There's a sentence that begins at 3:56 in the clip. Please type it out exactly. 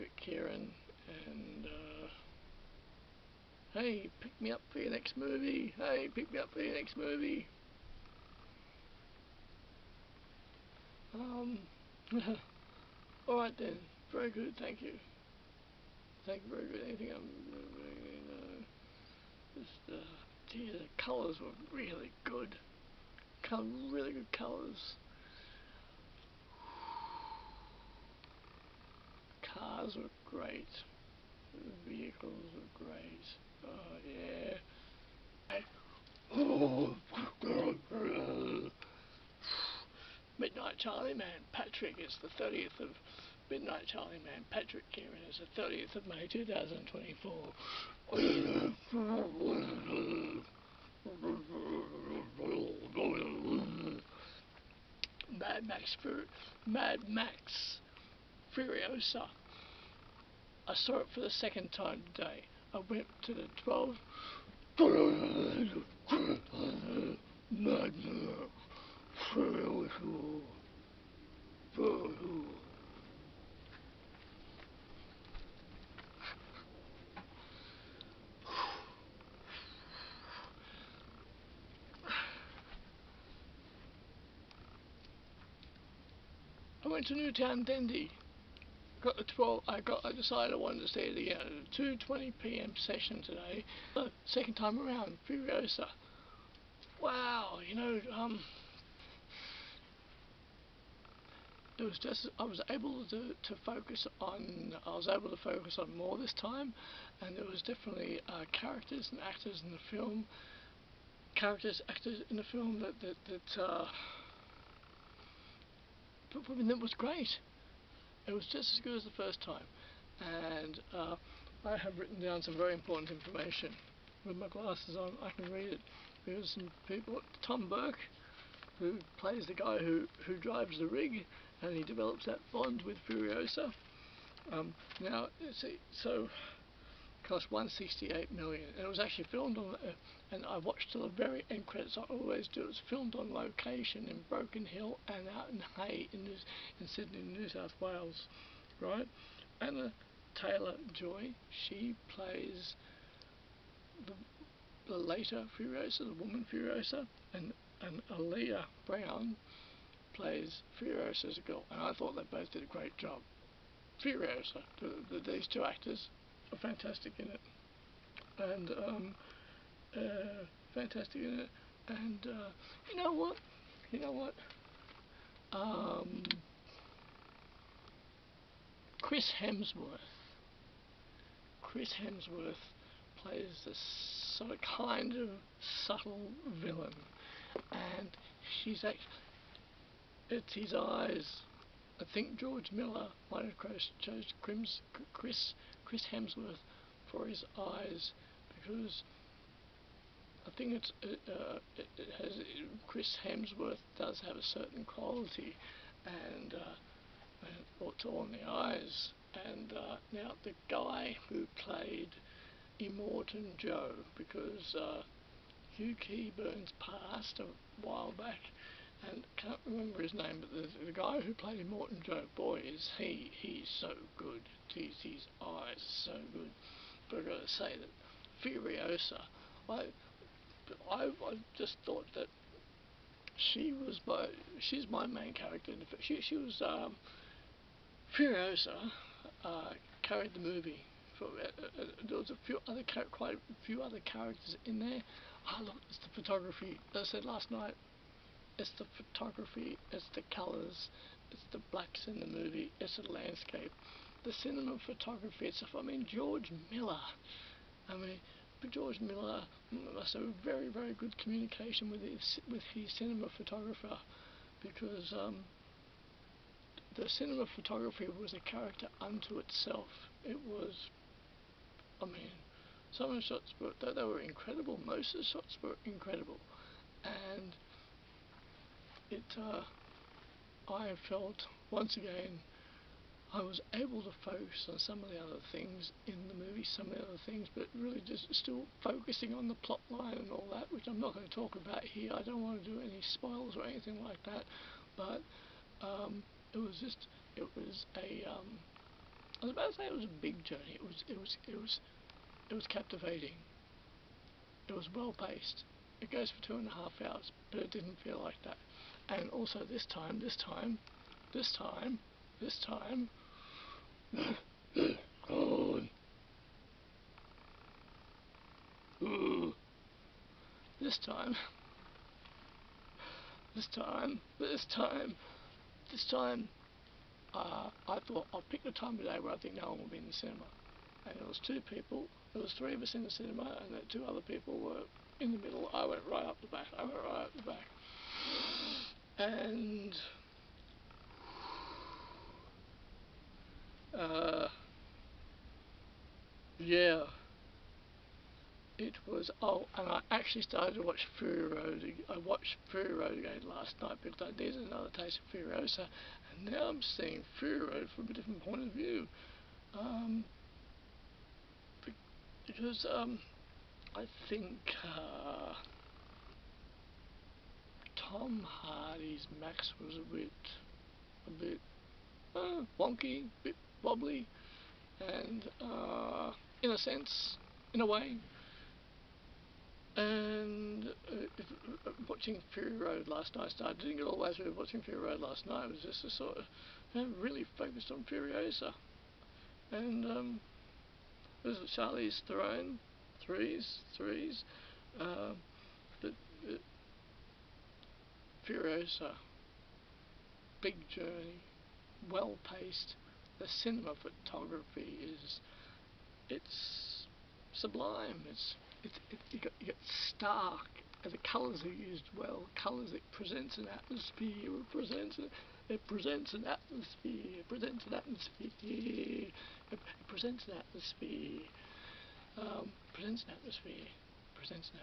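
She, she was, um, Furiosa uh, carried the movie.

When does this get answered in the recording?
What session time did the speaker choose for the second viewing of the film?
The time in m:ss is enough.
1:31.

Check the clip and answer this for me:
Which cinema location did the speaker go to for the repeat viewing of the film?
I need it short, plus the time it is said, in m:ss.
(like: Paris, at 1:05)
Newtown Dendy, at 1:27.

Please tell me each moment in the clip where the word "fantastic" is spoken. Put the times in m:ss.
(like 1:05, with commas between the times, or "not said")
2:46, 2:50.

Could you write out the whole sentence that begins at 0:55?
Mad Max Fur Mad Max Furiosa I saw it for the second time today.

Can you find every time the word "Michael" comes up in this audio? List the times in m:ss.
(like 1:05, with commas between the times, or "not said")
not said.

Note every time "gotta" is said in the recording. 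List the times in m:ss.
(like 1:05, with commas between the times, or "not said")
3:47.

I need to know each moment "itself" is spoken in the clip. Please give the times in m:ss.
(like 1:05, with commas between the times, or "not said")
4:15, 4:29.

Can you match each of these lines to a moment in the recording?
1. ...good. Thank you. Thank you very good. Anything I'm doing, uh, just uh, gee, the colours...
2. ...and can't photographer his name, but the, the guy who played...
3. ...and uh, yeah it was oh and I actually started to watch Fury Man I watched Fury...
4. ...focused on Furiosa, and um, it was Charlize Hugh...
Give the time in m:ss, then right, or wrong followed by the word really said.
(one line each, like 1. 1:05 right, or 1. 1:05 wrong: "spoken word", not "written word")
1. 0:14 right
2. 3:39 wrong: "remember", not "photographer"
3. 5:39 wrong: "Road", not "Man"
4. 6:27 wrong: "Theron", not "Hugh".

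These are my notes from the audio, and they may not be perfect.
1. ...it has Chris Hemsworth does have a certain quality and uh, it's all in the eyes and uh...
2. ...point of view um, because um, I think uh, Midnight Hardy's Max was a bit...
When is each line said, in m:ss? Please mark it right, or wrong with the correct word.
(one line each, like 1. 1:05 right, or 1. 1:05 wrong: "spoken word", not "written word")
1. 3:21 right
2. 5:58 wrong: "Tom", not "Midnight".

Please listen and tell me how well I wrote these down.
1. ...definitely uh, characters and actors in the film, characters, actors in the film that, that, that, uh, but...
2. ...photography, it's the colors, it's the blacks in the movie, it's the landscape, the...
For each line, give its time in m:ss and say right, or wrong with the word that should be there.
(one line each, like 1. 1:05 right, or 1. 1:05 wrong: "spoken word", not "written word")
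1. 1:47 right
2. 4:08 right.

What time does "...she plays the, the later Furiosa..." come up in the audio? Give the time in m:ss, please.
2:31.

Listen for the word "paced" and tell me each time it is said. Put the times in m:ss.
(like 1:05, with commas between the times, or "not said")
5:05, 6:42.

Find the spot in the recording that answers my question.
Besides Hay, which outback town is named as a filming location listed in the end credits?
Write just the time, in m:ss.
2:24.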